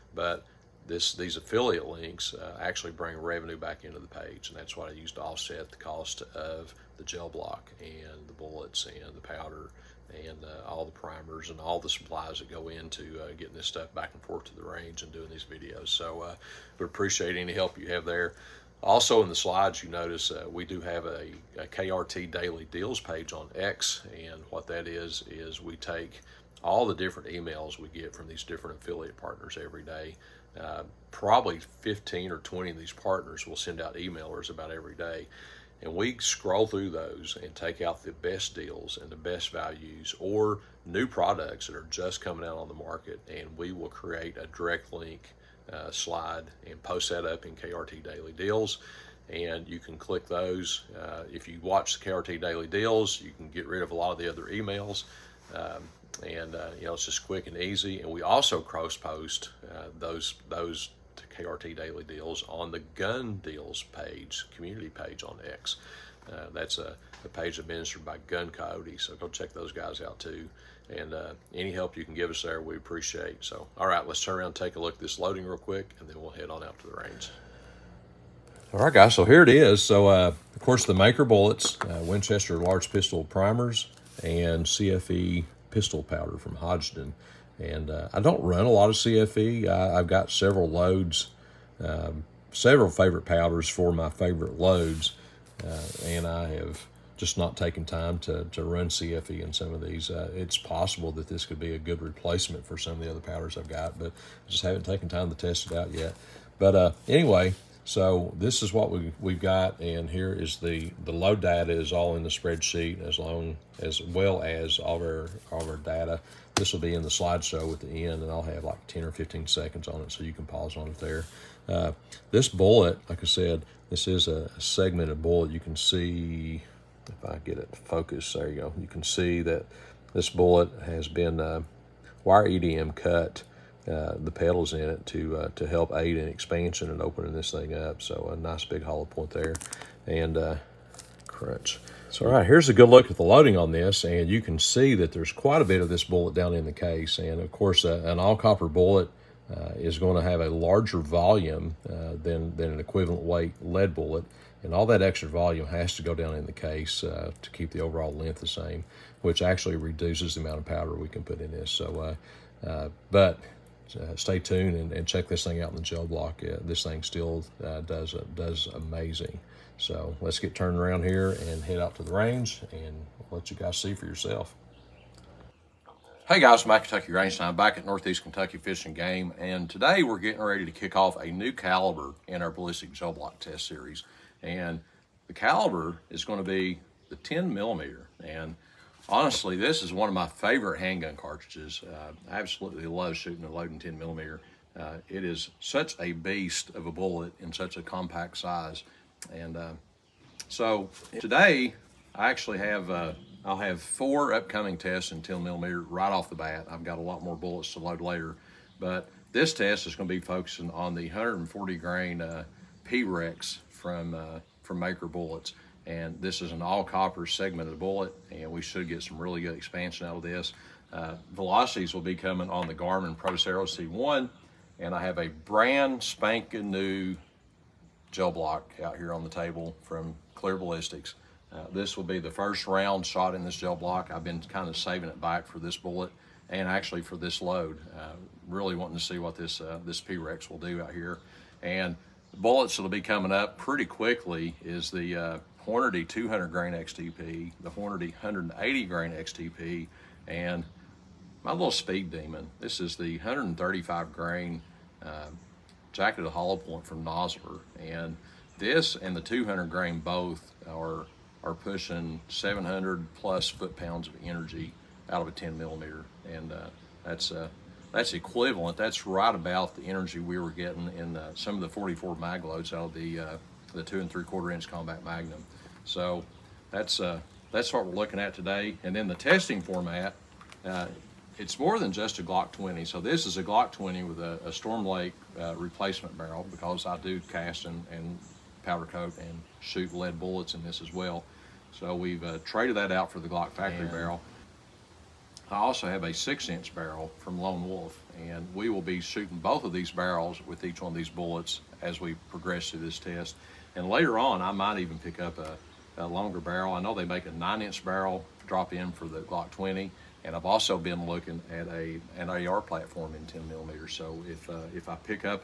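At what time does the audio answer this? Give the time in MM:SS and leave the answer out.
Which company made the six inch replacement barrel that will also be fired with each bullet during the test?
04:57.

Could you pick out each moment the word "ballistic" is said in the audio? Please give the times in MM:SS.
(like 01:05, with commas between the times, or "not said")
03:02, 03:50.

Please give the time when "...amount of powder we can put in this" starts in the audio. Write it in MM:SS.
02:40.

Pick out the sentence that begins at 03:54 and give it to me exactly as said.
I've been kind of saving it back for this bullet and actually for this load.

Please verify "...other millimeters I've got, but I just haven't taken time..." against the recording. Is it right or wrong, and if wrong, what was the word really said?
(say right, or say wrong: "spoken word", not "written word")
wrong: "powders", not "millimeters".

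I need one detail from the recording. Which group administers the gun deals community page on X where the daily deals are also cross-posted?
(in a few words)
Gun Coyote.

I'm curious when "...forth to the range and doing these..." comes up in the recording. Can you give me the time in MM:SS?
00:14.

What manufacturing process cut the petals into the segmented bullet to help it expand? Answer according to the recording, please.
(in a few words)
wire EDM.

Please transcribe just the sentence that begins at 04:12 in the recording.
This is the 135 grain uh, jacketed hollow point from Nosler.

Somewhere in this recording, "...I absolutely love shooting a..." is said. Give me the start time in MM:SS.
03:12.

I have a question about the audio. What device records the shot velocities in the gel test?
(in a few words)
Garmin Pro Xero C1.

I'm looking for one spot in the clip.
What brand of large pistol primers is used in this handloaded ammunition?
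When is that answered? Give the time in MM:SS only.
01:22.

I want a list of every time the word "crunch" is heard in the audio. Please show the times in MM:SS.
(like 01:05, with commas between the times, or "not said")
02:21.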